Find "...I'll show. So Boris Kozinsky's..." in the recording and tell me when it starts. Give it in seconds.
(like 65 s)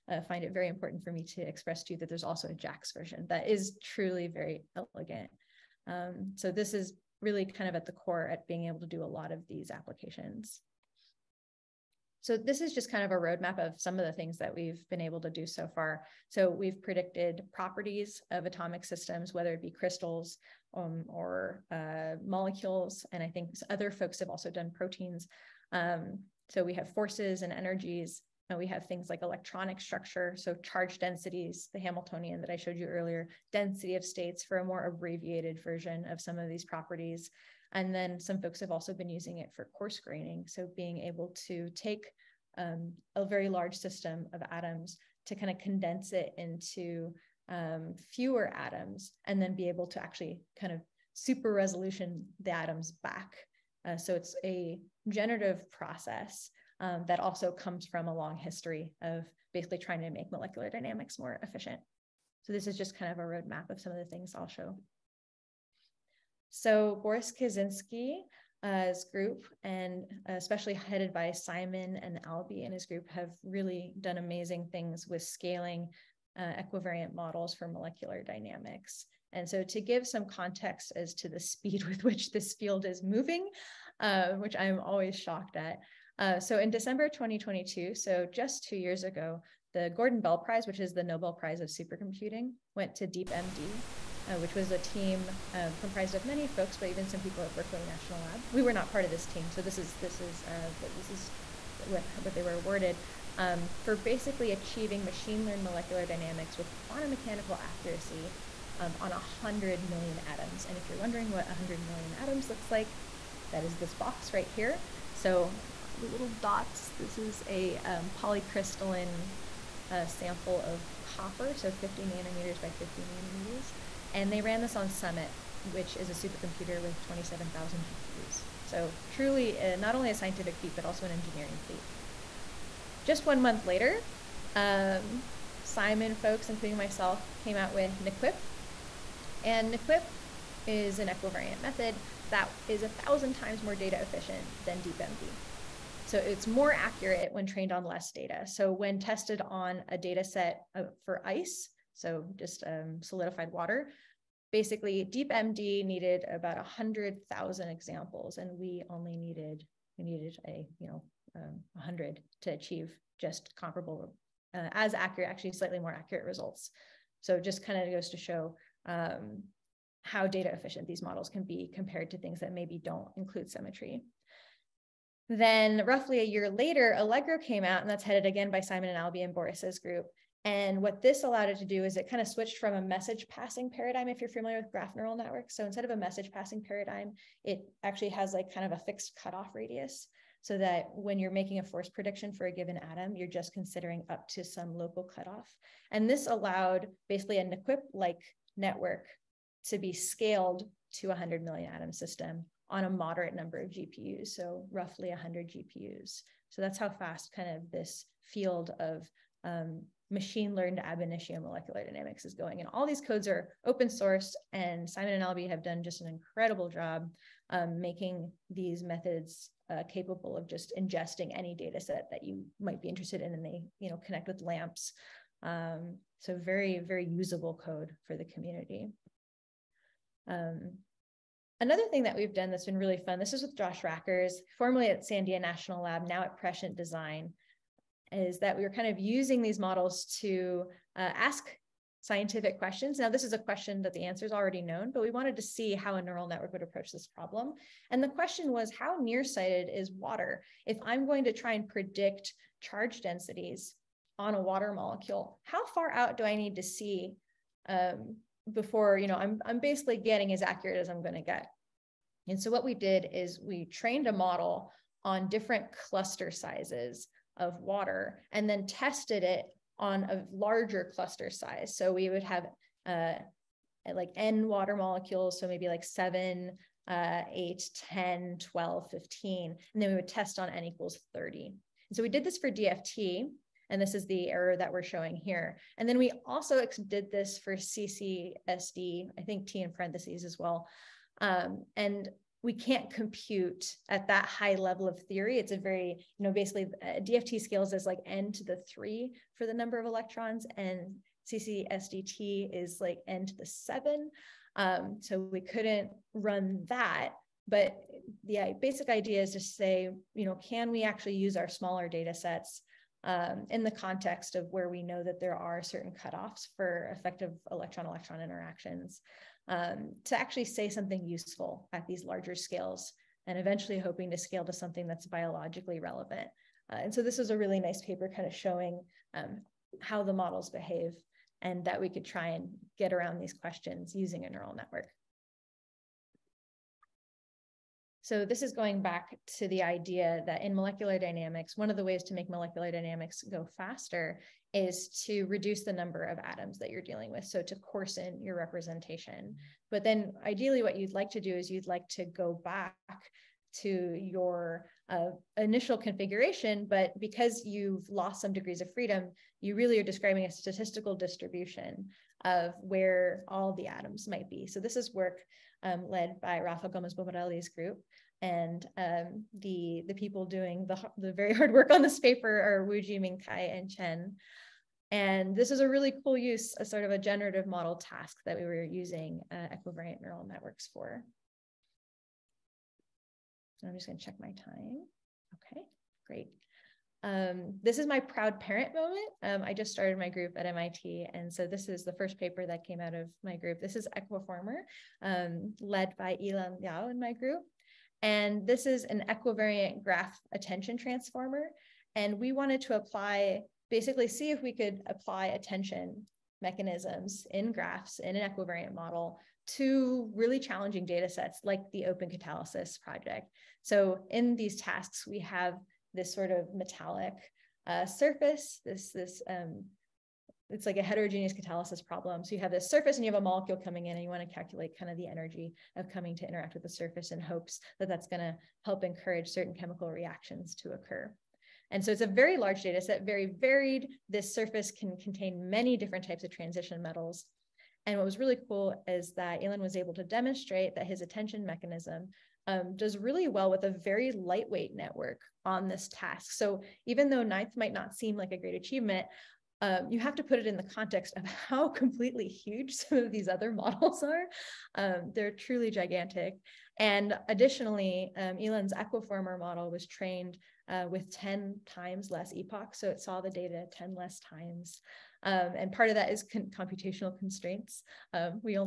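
64 s.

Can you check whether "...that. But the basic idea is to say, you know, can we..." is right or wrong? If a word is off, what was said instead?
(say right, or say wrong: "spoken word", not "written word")
right.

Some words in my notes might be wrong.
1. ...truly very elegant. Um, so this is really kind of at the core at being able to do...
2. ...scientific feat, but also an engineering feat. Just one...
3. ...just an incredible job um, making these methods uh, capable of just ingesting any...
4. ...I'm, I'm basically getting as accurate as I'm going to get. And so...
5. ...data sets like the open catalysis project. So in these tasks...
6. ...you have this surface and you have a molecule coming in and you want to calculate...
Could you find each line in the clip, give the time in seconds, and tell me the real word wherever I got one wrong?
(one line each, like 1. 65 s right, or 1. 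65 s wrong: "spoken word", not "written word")
1. 3 s right
2. 130 s right
3. 215 s right
4. 259 s right
5. 410 s right
6. 422 s right.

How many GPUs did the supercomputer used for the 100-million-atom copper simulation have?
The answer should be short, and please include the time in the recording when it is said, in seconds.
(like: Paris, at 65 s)
27,000, at 127 s.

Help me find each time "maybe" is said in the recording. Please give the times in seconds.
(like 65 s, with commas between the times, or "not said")
172 s, 275 s.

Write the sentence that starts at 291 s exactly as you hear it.
Um, and we can't compute at that high level of theory.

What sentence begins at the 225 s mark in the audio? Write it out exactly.
Um, so very very usable code for the community.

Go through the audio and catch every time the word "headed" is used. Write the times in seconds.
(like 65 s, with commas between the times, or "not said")
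70 s, 178 s.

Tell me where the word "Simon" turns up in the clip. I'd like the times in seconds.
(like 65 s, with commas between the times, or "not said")
71 s, 135 s, 178 s, 214 s.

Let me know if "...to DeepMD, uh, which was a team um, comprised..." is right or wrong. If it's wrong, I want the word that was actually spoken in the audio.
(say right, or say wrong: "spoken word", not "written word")
right.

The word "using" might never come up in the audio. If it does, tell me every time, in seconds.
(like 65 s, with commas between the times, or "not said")
39 s, 238 s, 333 s, 378 s.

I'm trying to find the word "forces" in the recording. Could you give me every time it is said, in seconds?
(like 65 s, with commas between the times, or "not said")
26 s, 191 s.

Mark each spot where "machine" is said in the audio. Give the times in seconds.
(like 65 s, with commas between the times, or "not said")
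105 s, 210 s.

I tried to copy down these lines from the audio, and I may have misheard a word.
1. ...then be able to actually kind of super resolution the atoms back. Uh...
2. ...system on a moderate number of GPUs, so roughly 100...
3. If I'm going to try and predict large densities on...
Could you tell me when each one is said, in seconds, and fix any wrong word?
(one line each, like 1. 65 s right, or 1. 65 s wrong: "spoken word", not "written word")
1. 49 s right
2. 201 s right
3. 250 s wrong: "charge", not "large".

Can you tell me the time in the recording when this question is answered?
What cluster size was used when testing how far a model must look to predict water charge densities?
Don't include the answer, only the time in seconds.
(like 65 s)
280 s.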